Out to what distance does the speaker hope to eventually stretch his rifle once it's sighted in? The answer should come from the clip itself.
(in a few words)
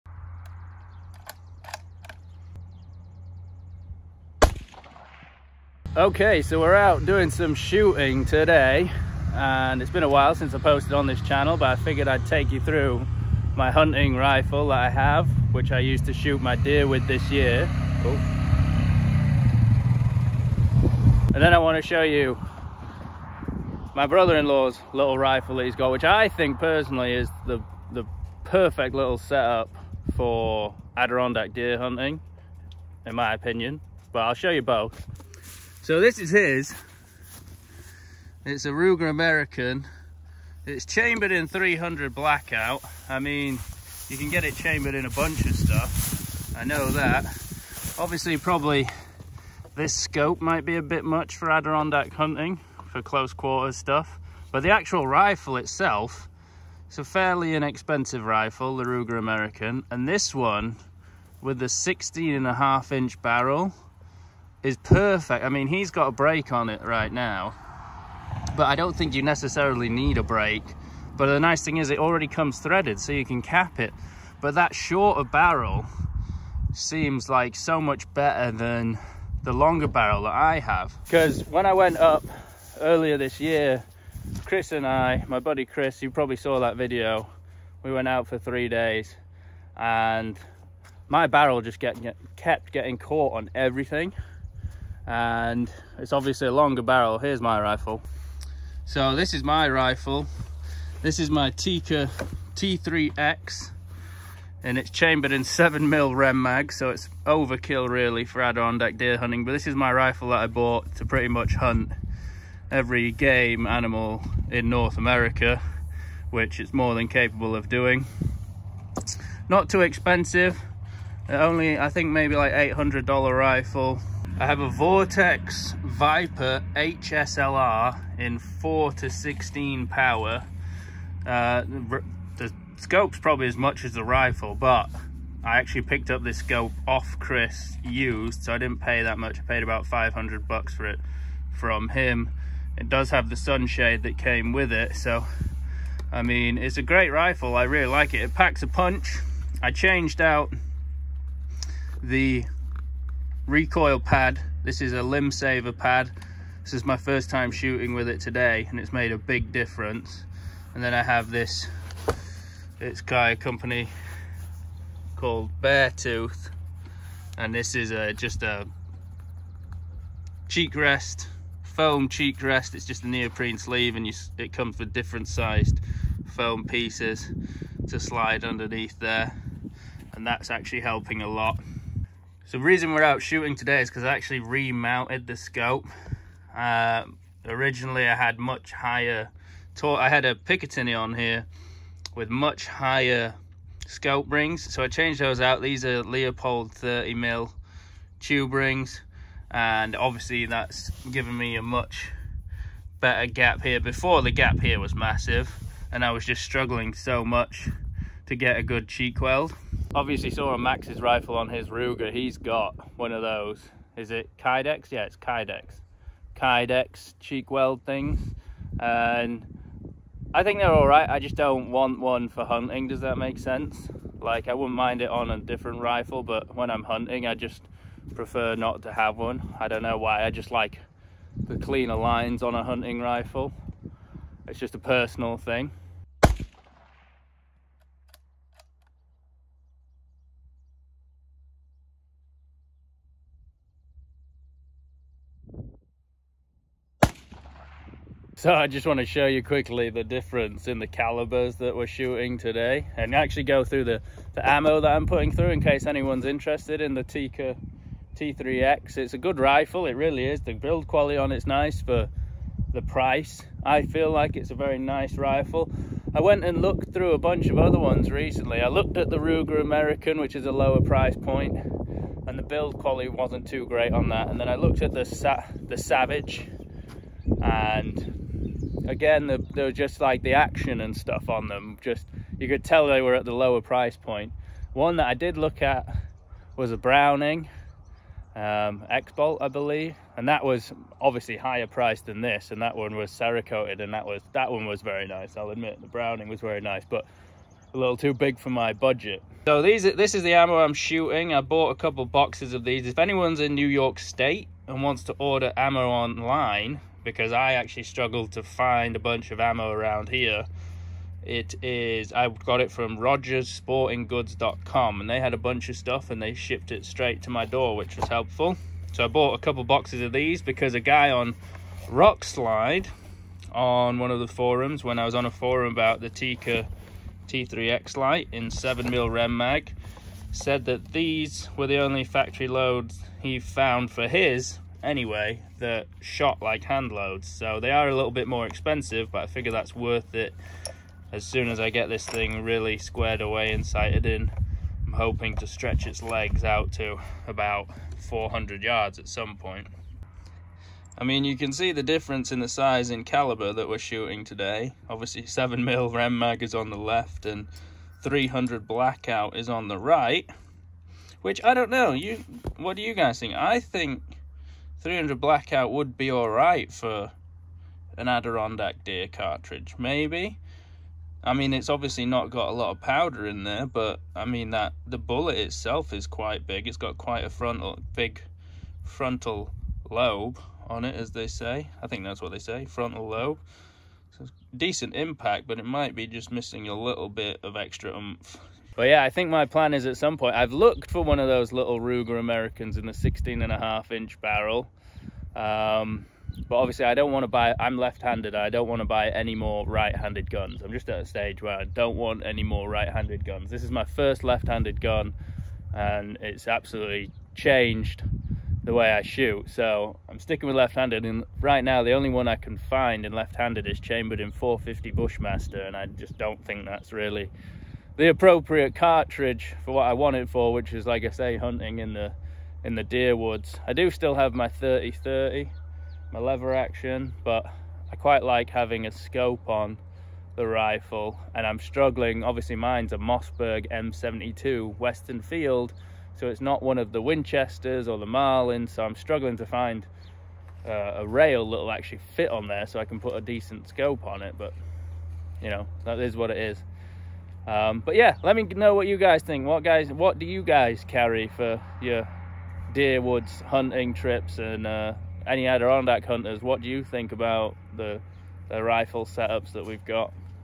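400 yards.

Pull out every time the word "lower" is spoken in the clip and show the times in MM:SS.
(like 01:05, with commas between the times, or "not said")
04:30, 04:43.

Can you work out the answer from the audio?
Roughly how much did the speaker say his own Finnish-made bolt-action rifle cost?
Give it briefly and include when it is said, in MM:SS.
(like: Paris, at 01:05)
$800, at 02:02.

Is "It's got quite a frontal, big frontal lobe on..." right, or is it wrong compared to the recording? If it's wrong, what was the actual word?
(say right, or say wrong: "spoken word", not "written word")
right.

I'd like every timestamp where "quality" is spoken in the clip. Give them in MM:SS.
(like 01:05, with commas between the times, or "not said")
04:20, 04:32.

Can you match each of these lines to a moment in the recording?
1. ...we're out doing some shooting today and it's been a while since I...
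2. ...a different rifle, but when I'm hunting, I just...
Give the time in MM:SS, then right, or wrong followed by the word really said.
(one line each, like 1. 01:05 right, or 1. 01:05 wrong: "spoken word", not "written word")
1. 00:06 right
2. 03:45 right.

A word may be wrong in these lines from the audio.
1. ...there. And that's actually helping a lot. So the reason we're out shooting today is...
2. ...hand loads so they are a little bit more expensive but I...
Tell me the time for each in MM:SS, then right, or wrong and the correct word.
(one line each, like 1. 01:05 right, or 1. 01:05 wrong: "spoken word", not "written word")
1. 02:58 right
2. 05:36 right.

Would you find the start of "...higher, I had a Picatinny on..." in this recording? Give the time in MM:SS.
03:08.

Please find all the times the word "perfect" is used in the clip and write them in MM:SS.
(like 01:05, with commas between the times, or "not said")
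00:28, 01:04.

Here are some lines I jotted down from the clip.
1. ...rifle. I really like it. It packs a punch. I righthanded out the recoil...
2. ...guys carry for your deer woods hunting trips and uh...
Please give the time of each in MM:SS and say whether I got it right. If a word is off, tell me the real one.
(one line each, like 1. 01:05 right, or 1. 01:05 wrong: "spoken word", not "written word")
1. 02:27 wrong: "changed", not "righthanded"
2. 07:30 right.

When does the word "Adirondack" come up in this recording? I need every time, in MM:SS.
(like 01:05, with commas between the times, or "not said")
00:30, 00:51, 01:48, 06:08, 07:35.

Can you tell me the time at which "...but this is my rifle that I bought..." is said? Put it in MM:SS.
01:49.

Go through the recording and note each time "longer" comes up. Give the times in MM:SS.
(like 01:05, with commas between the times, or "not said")
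01:19, 01:36.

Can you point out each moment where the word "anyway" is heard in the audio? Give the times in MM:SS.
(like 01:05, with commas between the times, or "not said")
05:34.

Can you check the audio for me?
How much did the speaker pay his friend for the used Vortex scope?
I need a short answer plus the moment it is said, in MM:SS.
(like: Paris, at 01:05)
$500, at 02:19.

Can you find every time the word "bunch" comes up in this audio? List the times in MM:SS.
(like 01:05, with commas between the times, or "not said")
00:45, 04:27, 05:08, 05:15.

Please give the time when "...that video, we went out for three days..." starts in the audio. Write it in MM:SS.
01:26.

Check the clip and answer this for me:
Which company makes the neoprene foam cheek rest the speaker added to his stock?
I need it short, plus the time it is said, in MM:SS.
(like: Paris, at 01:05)
Beartooth, at 02:45.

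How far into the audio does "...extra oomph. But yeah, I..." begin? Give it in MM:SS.
06:27.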